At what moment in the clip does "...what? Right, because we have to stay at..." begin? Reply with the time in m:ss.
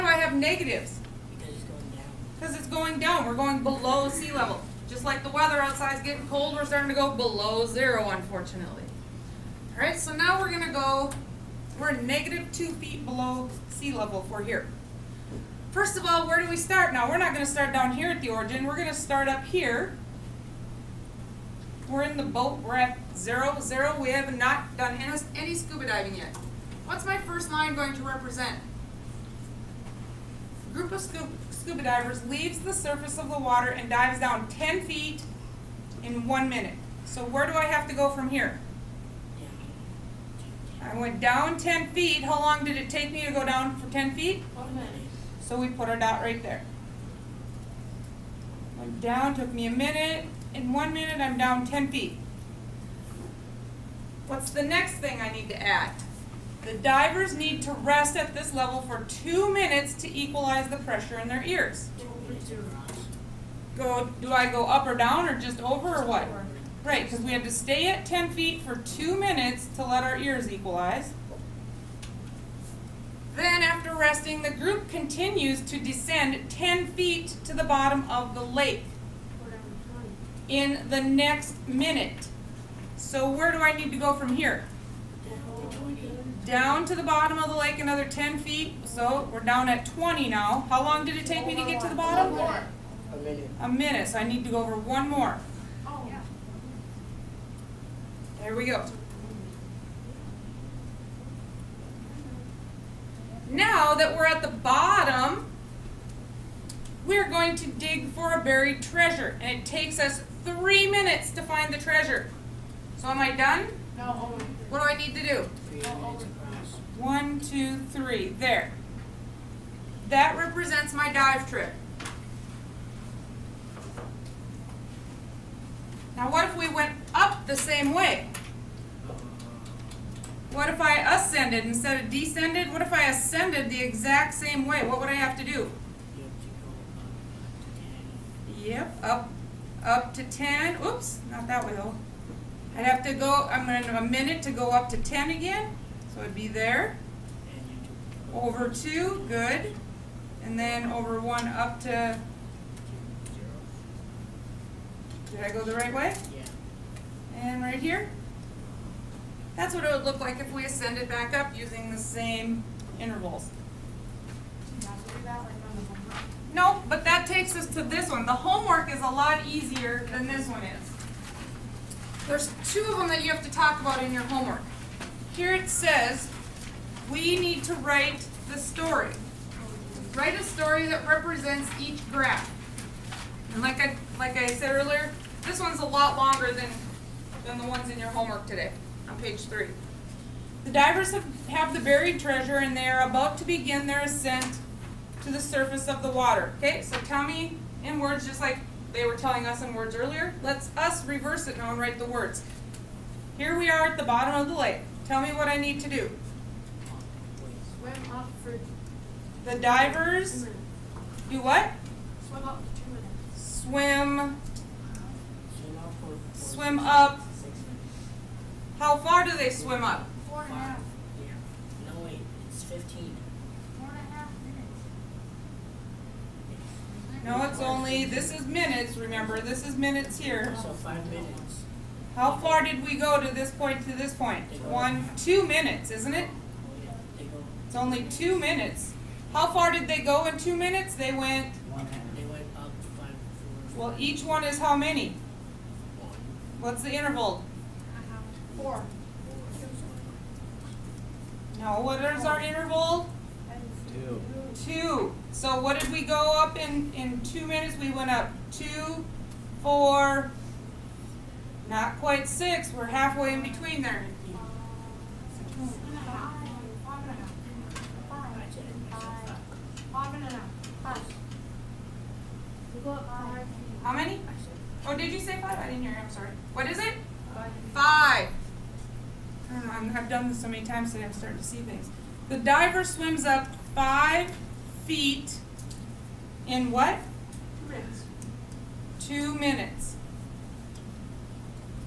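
1:06.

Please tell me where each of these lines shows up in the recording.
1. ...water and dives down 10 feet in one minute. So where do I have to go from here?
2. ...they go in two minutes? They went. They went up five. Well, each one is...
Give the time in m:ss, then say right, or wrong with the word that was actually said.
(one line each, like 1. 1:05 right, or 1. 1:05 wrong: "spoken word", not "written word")
1. 0:33 right
2. 3:59 right.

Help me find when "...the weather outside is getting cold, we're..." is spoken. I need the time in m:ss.
0:05.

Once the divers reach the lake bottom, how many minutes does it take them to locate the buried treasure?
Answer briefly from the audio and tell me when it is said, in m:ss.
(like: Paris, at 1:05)
3 minutes, at 1:50.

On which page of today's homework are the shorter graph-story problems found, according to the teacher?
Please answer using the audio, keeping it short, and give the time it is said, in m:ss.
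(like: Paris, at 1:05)
Page 3, at 3:09.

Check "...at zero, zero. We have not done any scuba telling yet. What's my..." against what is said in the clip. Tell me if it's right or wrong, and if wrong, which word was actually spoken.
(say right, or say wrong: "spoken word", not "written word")
wrong: "diving", not "telling".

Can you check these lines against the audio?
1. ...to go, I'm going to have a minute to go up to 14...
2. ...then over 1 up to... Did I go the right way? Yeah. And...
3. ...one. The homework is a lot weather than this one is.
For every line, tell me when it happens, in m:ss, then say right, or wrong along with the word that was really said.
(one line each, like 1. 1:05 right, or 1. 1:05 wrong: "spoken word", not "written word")
1. 2:23 wrong: "10", not "14"
2. 2:30 right
3. 2:48 wrong: "easier", not "weather".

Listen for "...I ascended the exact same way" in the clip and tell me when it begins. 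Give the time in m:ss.
2:12.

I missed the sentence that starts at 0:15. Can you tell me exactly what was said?
First of all, where do we start now?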